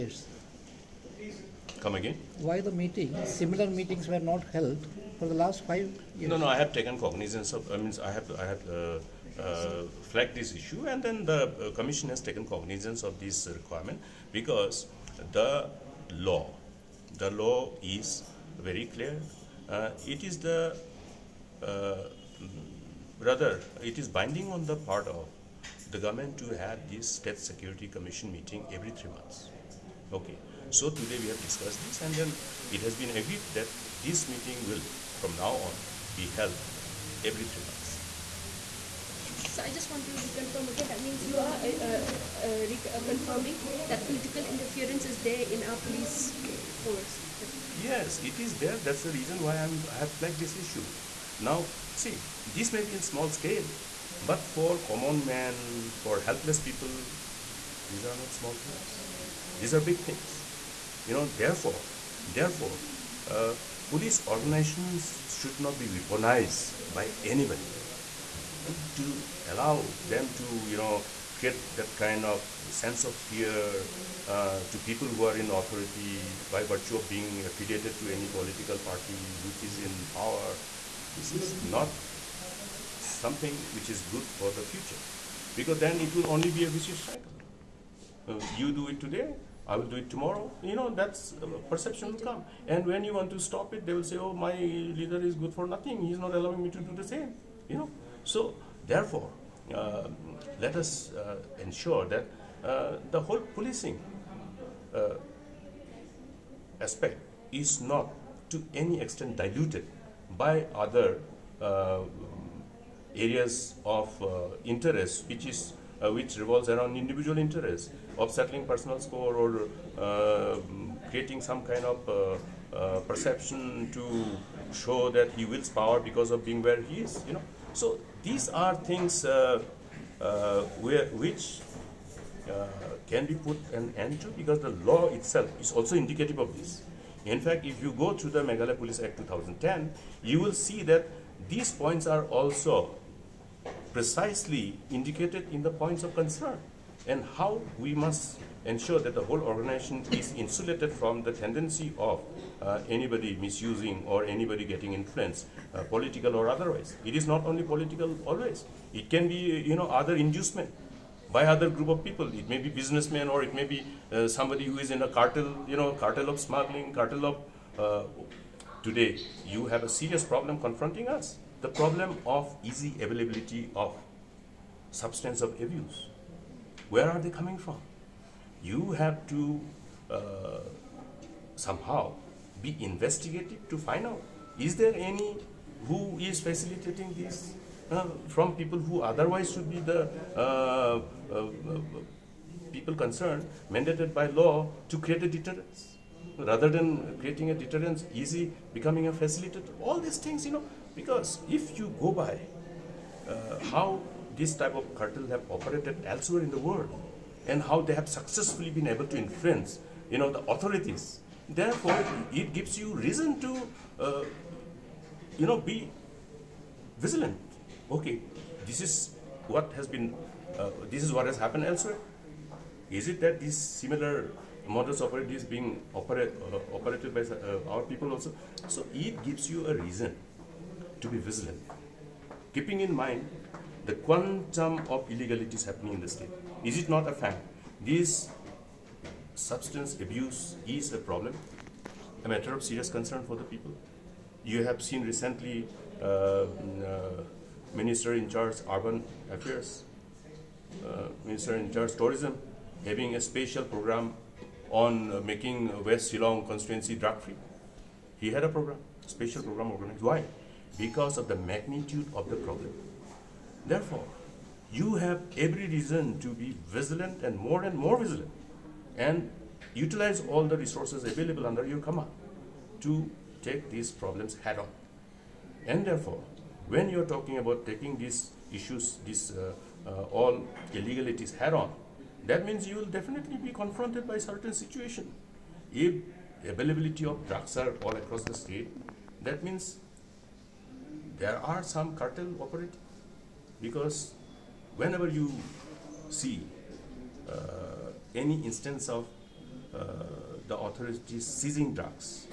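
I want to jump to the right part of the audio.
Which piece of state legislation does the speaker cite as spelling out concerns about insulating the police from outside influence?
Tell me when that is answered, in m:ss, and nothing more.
2:18.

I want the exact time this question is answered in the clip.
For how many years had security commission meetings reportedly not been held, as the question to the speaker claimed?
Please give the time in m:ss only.
0:05.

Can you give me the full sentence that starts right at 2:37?
It is not only political always.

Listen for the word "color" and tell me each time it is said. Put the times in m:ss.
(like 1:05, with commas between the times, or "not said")
not said.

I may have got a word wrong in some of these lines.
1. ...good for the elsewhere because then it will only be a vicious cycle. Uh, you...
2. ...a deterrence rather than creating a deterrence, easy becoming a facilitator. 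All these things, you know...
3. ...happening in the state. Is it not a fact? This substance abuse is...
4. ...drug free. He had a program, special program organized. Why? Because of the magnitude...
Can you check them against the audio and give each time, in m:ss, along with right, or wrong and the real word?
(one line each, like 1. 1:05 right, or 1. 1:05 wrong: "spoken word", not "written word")
1. 1:24 wrong: "future", not "elsewhere"
2. 3:15 right
3. 3:55 right
4. 4:16 right.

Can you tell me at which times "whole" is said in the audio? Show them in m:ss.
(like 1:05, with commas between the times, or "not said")
1:43, 2:29.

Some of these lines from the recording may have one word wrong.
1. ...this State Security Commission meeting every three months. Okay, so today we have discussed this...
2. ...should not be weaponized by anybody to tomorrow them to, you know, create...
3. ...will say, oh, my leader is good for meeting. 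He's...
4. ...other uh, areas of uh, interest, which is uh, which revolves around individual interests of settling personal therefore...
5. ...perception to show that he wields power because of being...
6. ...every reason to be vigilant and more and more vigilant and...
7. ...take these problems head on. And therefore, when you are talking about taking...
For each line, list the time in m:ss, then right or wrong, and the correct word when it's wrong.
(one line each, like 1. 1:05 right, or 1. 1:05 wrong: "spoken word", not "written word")
1. 0:26 right
2. 1:05 wrong: "allow", not "tomorrow"
3. 1:33 wrong: "nothing", not "meeting"
4. 1:50 wrong: "score", not "therefore"
5. 2:03 right
6. 4:25 right
7. 4:33 right.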